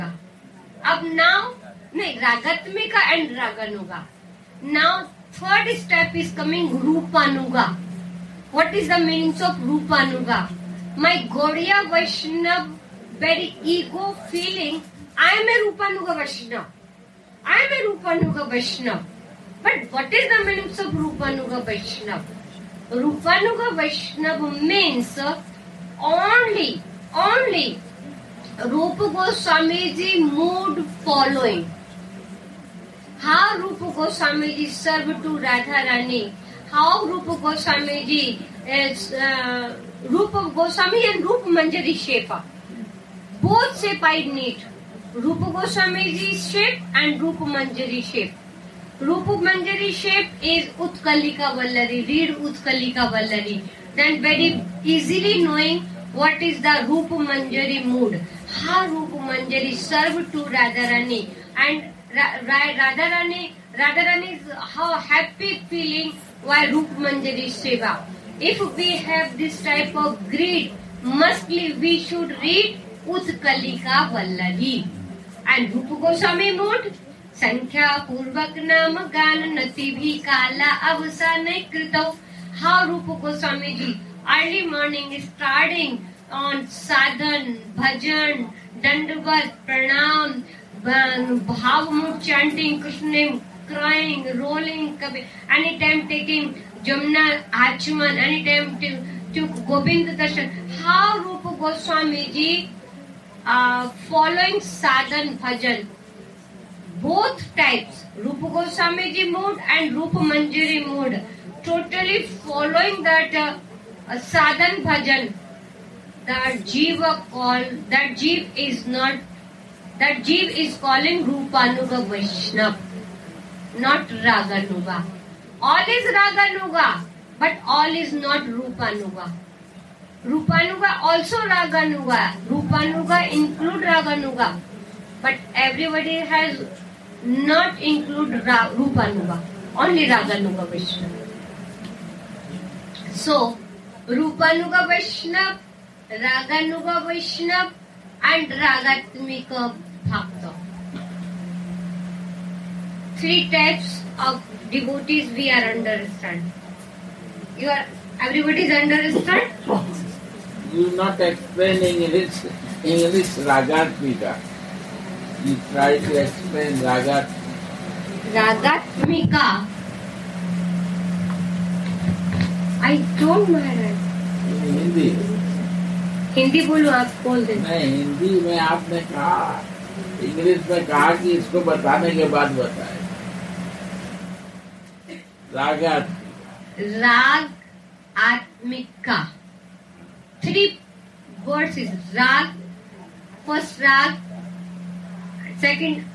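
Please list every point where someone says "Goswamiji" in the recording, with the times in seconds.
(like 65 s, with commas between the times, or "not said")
45 s.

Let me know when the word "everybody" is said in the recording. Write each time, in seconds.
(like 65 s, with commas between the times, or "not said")
135 s, 158 s.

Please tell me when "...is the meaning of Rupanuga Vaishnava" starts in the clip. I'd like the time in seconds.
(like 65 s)
20 s.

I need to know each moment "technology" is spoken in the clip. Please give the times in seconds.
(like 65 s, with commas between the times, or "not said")
not said.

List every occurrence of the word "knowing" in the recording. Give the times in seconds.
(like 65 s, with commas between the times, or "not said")
55 s.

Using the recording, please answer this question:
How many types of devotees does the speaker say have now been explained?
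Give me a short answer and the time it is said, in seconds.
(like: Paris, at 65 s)
3, at 153 s.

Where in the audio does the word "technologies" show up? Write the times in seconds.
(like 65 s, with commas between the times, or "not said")
not said.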